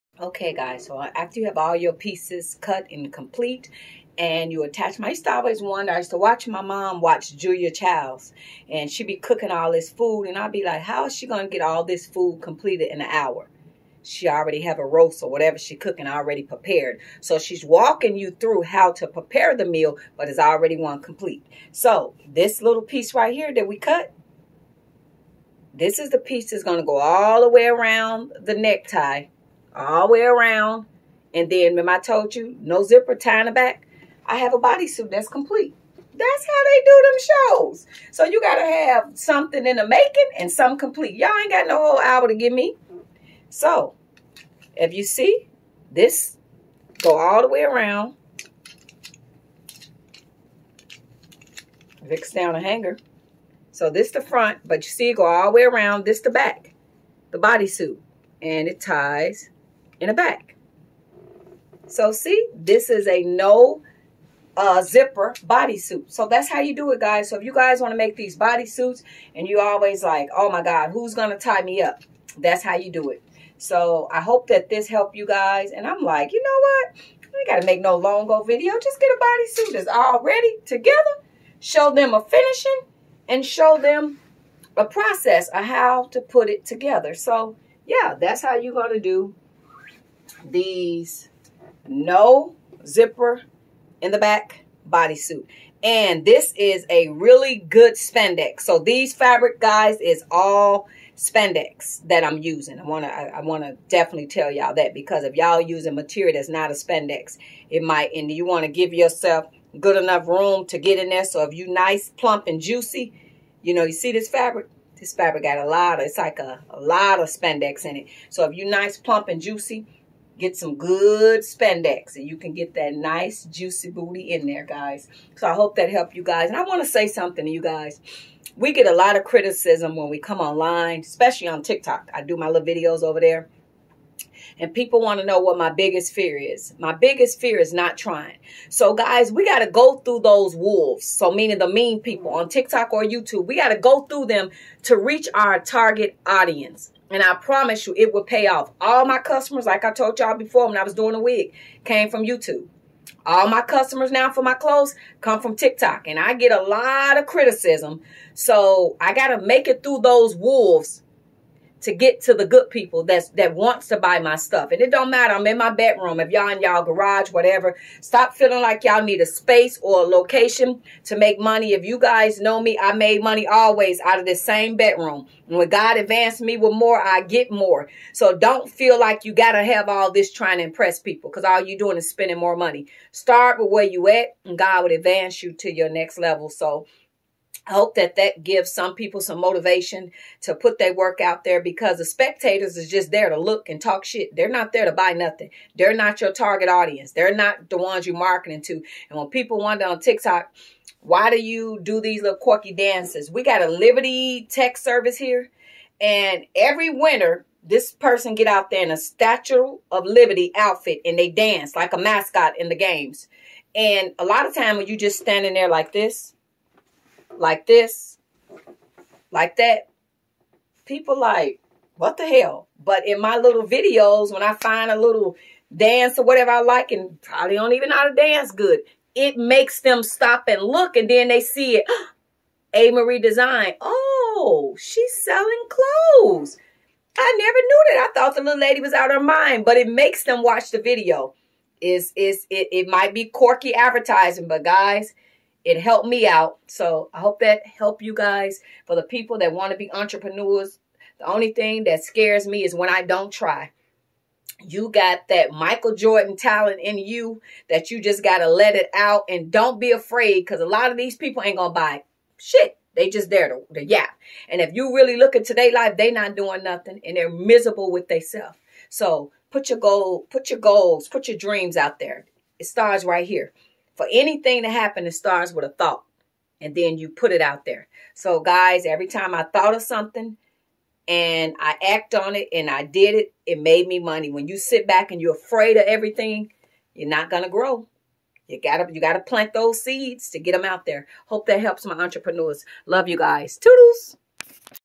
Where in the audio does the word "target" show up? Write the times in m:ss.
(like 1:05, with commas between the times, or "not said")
2:25, 3:16.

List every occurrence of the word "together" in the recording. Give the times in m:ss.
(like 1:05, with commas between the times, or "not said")
1:20, 1:26.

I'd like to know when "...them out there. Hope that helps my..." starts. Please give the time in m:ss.
4:50.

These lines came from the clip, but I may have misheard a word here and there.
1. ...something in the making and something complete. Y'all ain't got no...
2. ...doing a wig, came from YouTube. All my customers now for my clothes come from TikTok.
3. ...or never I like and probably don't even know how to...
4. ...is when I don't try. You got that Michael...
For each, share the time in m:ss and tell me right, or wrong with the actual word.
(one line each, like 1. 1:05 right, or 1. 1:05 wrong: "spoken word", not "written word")
1. 0:39 right
2. 2:30 right
3. 3:46 wrong: "whatever", not "never"
4. 4:12 right.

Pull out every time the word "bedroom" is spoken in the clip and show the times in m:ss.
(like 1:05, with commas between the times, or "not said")
2:45, 2:54.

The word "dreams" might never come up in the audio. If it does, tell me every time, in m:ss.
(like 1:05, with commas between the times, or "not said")
4:31.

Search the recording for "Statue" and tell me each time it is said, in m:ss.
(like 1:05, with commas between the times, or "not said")
3:28.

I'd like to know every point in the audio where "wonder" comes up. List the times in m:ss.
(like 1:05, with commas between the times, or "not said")
0:05, 3:19.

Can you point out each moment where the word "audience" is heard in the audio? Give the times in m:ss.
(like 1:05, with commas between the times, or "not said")
2:26, 3:16.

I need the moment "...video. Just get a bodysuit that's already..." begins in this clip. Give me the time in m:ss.
1:18.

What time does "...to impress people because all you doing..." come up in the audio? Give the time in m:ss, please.
3:00.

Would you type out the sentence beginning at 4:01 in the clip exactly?
Is is it, it might be quirky advertising, but guys, it helped me out.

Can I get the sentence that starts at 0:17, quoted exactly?
So she's walking you through how to prepare the meal, but it's already one complete.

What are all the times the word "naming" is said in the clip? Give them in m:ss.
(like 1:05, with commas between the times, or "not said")
not said.